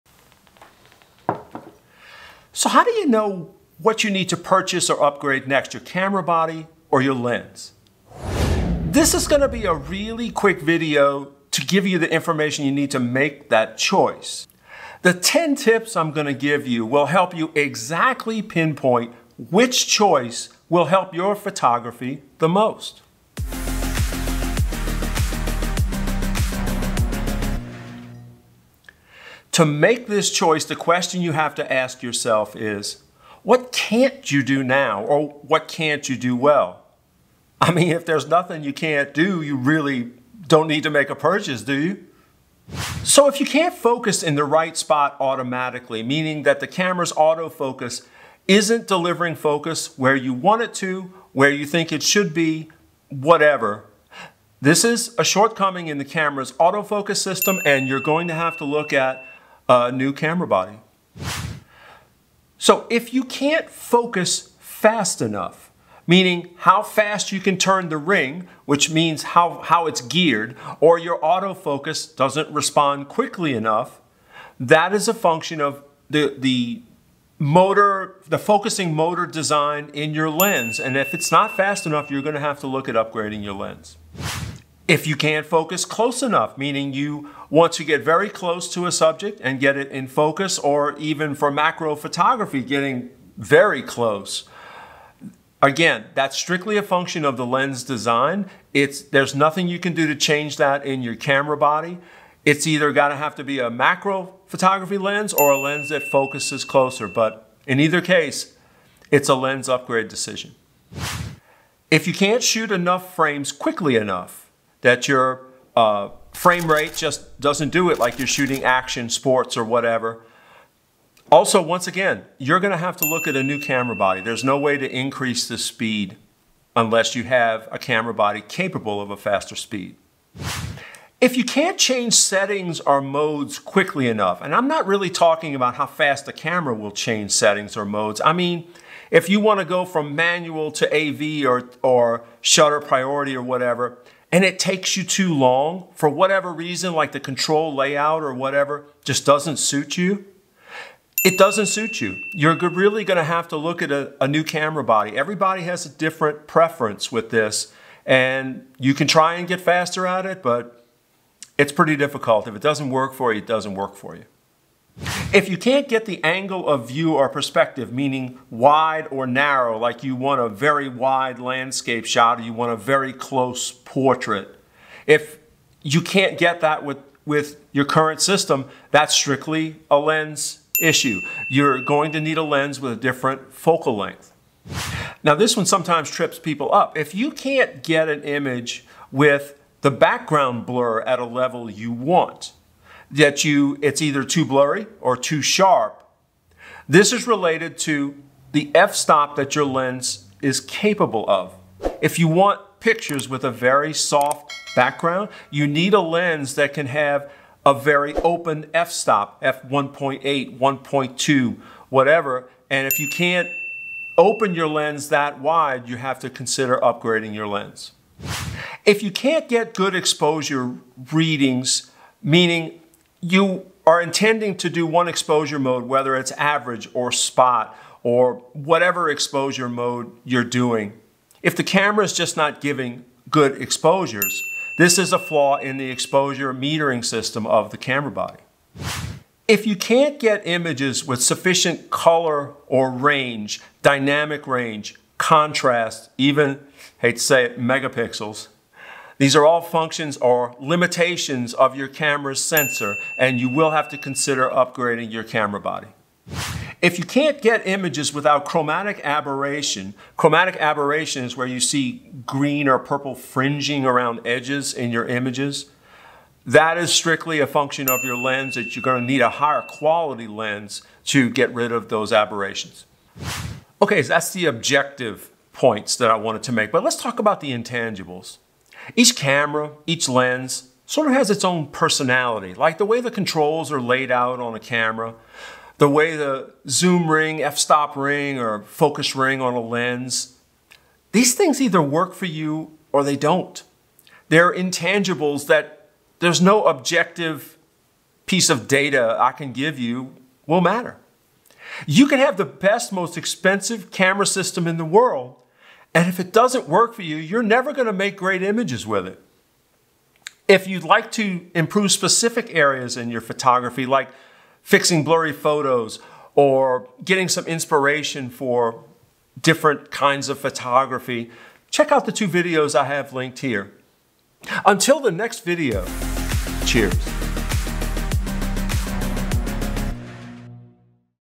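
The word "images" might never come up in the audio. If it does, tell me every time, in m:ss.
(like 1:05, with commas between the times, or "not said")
3:08, 4:00, 4:17, 4:25, 5:08.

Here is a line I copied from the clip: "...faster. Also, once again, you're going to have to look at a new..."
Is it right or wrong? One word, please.
wrong.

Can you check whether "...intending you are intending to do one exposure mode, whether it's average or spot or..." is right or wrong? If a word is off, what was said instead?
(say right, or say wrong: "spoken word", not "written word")
wrong: "meaning", not "intending".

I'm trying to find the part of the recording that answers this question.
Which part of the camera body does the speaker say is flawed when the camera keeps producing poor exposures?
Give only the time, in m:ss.
3:55.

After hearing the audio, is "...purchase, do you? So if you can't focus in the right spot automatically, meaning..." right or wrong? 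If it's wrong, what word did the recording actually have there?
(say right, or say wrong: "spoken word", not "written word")
right.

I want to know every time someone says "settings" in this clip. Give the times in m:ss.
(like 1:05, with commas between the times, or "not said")
2:12, 2:17.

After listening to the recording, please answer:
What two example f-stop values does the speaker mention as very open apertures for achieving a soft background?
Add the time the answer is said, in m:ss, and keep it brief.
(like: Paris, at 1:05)
f1.8, 1.2, at 3:29.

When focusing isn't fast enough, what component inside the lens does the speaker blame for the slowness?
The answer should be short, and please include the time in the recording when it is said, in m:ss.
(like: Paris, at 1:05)
focusing motor, at 1:18.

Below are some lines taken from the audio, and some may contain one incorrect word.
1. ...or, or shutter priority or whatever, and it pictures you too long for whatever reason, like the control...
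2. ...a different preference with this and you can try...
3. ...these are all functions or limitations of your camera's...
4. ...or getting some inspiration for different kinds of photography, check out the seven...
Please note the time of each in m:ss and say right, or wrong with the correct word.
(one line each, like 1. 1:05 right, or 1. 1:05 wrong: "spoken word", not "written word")
1. 2:21 wrong: "takes", not "pictures"
2. 2:35 right
3. 4:09 right
4. 5:16 wrong: "two", not "seven".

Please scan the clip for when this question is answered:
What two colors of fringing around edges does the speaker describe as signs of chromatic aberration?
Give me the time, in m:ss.
4:22.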